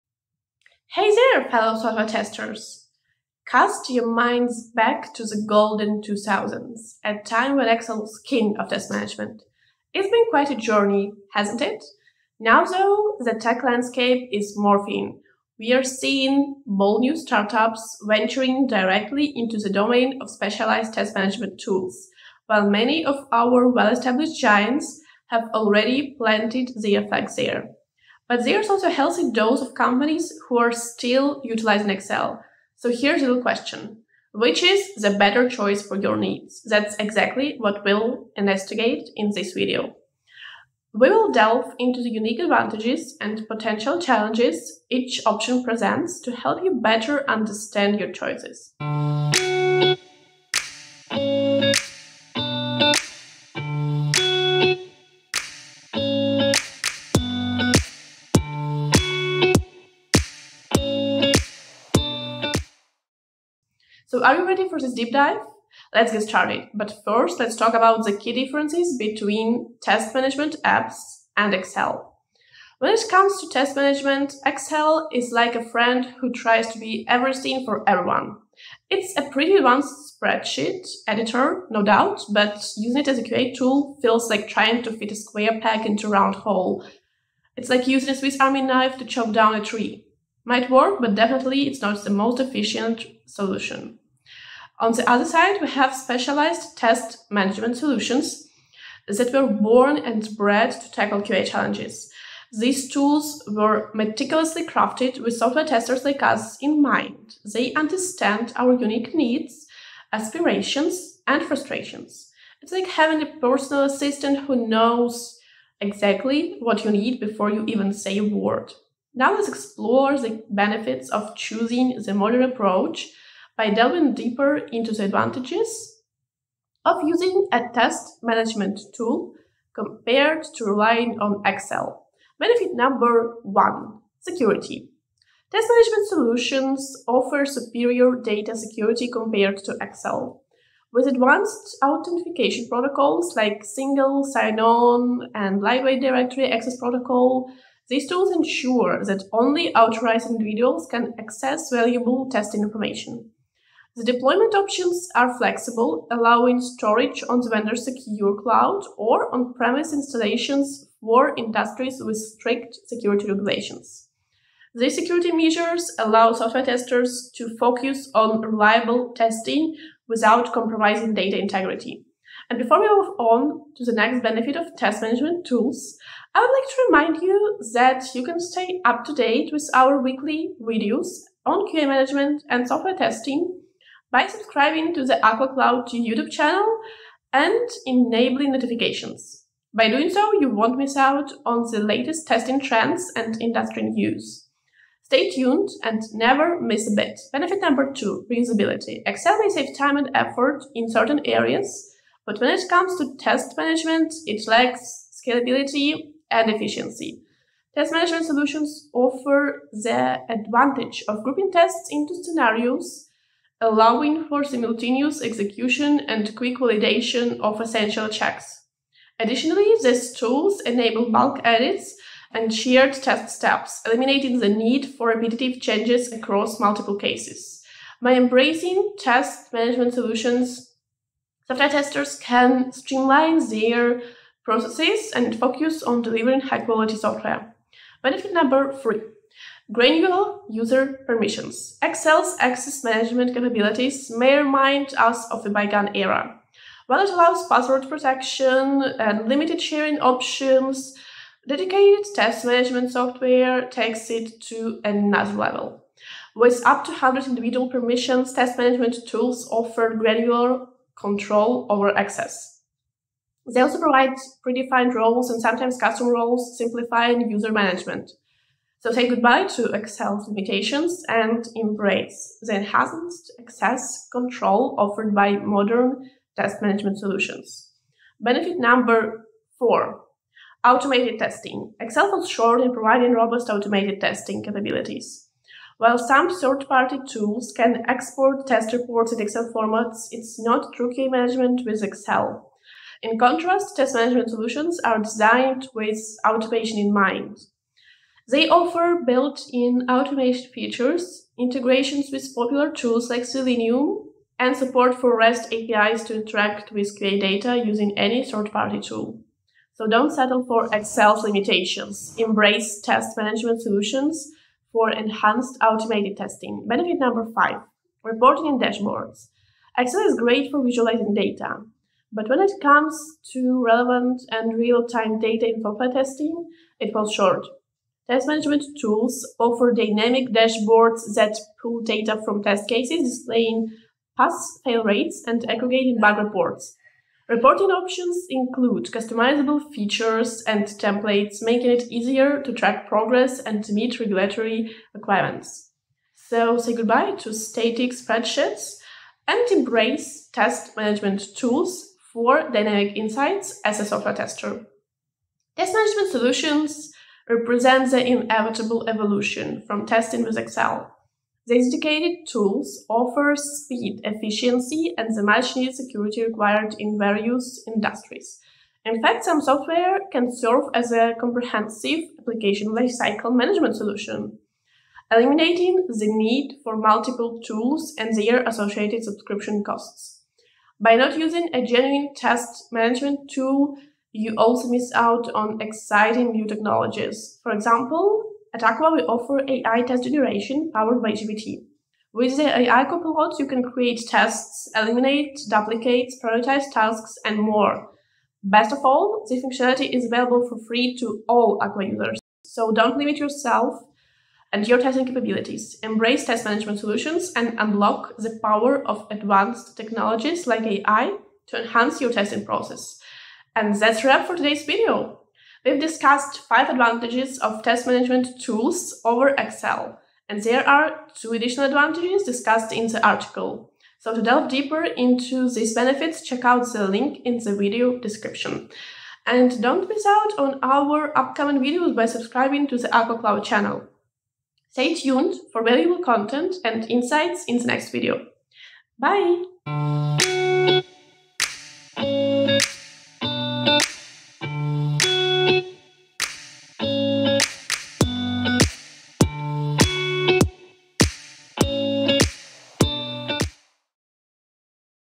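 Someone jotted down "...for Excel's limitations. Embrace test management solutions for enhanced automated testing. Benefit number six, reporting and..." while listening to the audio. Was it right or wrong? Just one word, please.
wrong.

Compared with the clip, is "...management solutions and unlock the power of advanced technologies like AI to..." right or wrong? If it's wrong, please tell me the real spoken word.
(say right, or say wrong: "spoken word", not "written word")
right.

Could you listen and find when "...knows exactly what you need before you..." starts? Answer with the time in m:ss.
1:54.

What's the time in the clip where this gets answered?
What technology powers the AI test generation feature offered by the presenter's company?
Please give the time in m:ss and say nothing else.
6:31.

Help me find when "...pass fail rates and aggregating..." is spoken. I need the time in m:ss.
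5:34.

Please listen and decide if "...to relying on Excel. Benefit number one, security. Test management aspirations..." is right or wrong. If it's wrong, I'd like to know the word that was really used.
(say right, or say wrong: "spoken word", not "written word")
wrong: "solutions", not "aspirations".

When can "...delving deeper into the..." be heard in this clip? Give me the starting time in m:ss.
2:03.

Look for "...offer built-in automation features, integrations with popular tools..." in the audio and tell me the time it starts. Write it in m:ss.
4:58.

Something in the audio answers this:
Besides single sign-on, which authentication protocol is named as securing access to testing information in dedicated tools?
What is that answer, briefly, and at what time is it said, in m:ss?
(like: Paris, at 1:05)
lightweight directory access protocol, at 2:25.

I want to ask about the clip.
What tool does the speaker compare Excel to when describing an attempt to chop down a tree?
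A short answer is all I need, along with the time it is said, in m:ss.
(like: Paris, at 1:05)
Swiss Army knife, at 1:28.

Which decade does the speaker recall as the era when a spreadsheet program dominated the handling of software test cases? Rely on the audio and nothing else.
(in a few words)
2000s.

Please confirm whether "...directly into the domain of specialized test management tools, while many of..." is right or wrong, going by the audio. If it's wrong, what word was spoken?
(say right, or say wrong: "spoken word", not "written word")
right.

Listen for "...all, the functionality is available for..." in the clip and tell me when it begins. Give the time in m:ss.
6:38.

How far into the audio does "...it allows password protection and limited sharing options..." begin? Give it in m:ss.
4:07.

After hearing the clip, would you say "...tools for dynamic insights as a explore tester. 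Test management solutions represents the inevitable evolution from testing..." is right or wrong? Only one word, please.
wrong.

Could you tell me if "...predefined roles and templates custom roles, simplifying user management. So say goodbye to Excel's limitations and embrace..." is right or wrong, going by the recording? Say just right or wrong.
wrong.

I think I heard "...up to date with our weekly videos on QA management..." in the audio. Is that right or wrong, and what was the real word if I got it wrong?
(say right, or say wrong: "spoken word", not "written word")
right.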